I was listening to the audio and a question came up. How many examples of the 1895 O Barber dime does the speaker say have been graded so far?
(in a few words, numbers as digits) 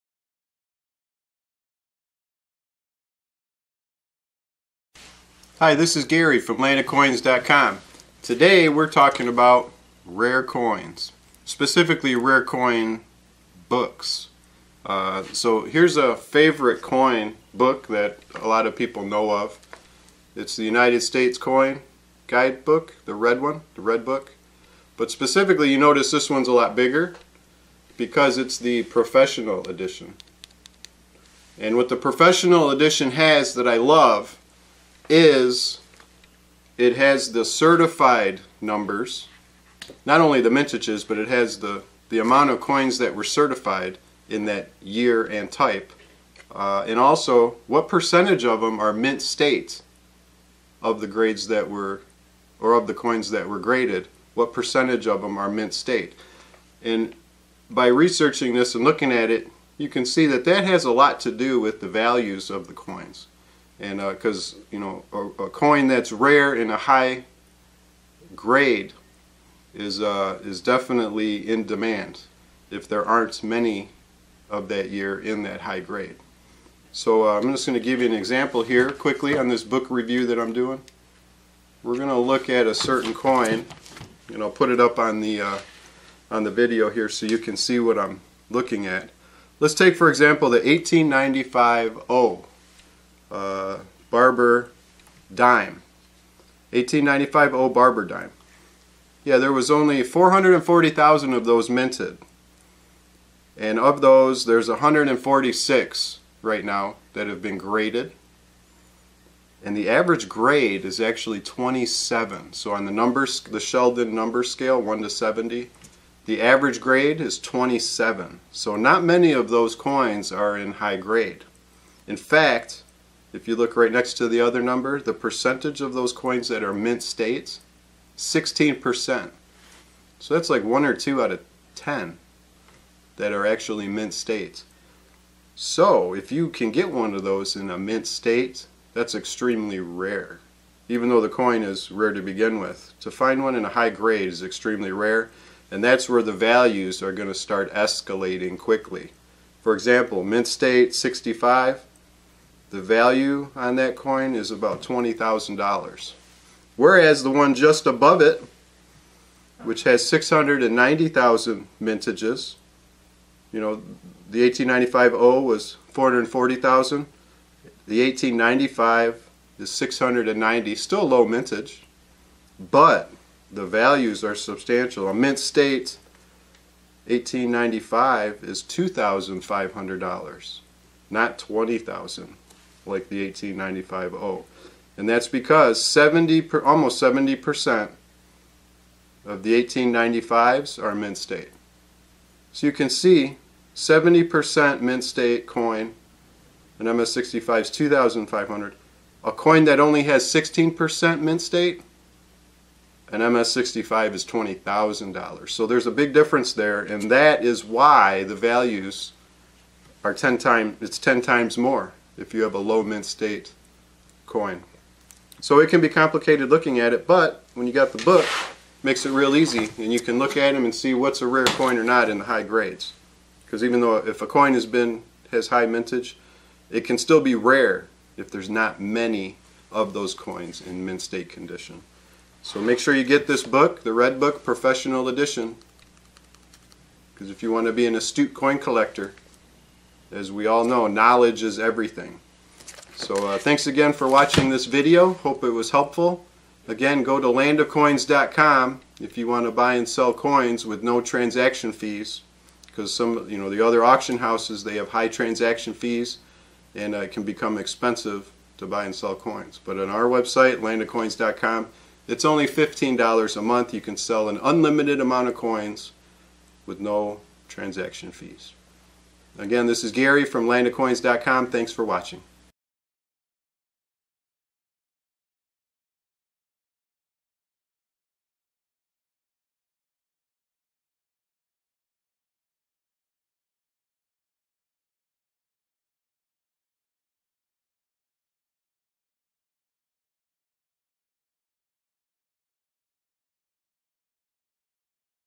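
146.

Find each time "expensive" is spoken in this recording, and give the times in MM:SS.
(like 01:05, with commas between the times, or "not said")
04:17.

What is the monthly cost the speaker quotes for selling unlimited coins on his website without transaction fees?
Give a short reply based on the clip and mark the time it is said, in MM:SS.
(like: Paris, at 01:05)
$15, at 04:22.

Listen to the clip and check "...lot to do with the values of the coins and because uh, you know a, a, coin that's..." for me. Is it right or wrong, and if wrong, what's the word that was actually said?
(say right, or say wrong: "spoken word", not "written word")
right.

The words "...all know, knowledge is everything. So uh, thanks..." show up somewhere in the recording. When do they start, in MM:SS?
04:00.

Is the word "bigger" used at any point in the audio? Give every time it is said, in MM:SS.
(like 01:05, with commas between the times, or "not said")
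00:26.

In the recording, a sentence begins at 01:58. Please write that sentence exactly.
So not many of those coins are in high grade.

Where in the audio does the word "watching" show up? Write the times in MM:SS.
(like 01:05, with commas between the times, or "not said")
04:04, 04:31.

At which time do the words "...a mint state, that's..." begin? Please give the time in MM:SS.
02:17.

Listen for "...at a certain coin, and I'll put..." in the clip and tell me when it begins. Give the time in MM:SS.
01:22.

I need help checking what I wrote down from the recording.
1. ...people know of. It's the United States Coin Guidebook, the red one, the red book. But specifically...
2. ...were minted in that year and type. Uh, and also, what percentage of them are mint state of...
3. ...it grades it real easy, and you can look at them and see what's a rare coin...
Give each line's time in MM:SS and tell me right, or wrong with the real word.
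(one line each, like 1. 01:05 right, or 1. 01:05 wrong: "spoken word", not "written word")
1. 00:18 right
2. 00:43 wrong: "certified", not "minted"
3. 03:38 wrong: "makes", not "grades".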